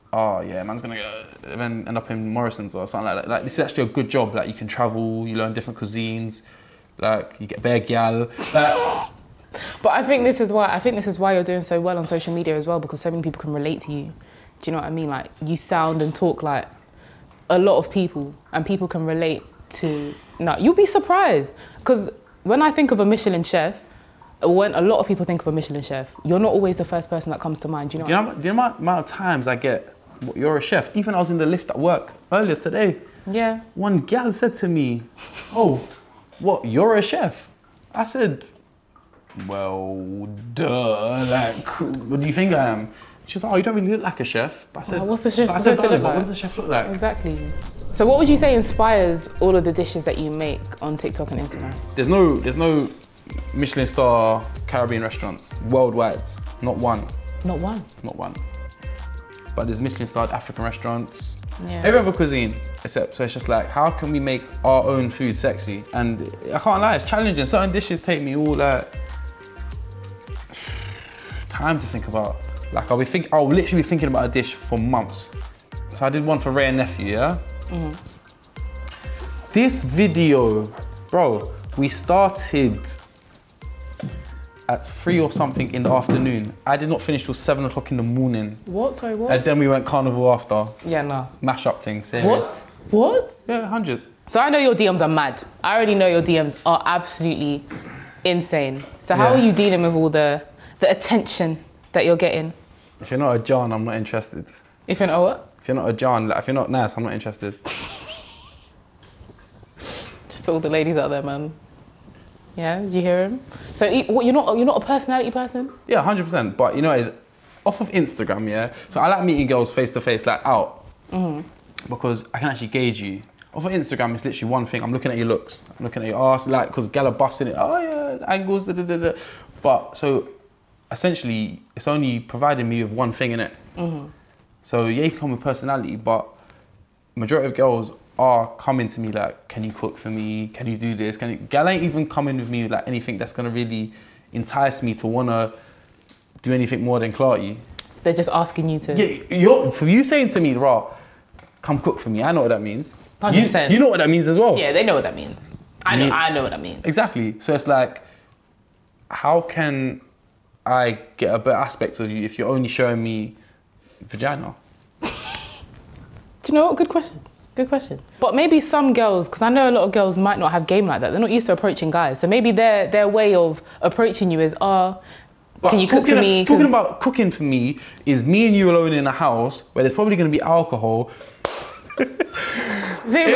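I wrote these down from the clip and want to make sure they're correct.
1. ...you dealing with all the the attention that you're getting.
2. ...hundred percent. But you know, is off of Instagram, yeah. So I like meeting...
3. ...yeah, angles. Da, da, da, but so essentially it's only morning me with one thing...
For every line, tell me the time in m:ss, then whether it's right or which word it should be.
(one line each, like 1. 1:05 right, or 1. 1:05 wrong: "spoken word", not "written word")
1. 1:39 right
2. 1:56 right
3. 2:07 wrong: "providing", not "morning".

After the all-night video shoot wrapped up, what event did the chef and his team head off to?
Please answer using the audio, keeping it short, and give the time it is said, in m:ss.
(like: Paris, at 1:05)
Carnival, at 1:29.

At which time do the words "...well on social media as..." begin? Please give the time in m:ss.
0:11.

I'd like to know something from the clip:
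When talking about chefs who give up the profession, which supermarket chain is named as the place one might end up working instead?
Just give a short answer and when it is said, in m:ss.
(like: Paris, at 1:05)
Morrison's, at 0:02.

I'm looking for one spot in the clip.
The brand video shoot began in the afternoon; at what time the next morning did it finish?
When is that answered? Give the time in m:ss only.
1:27.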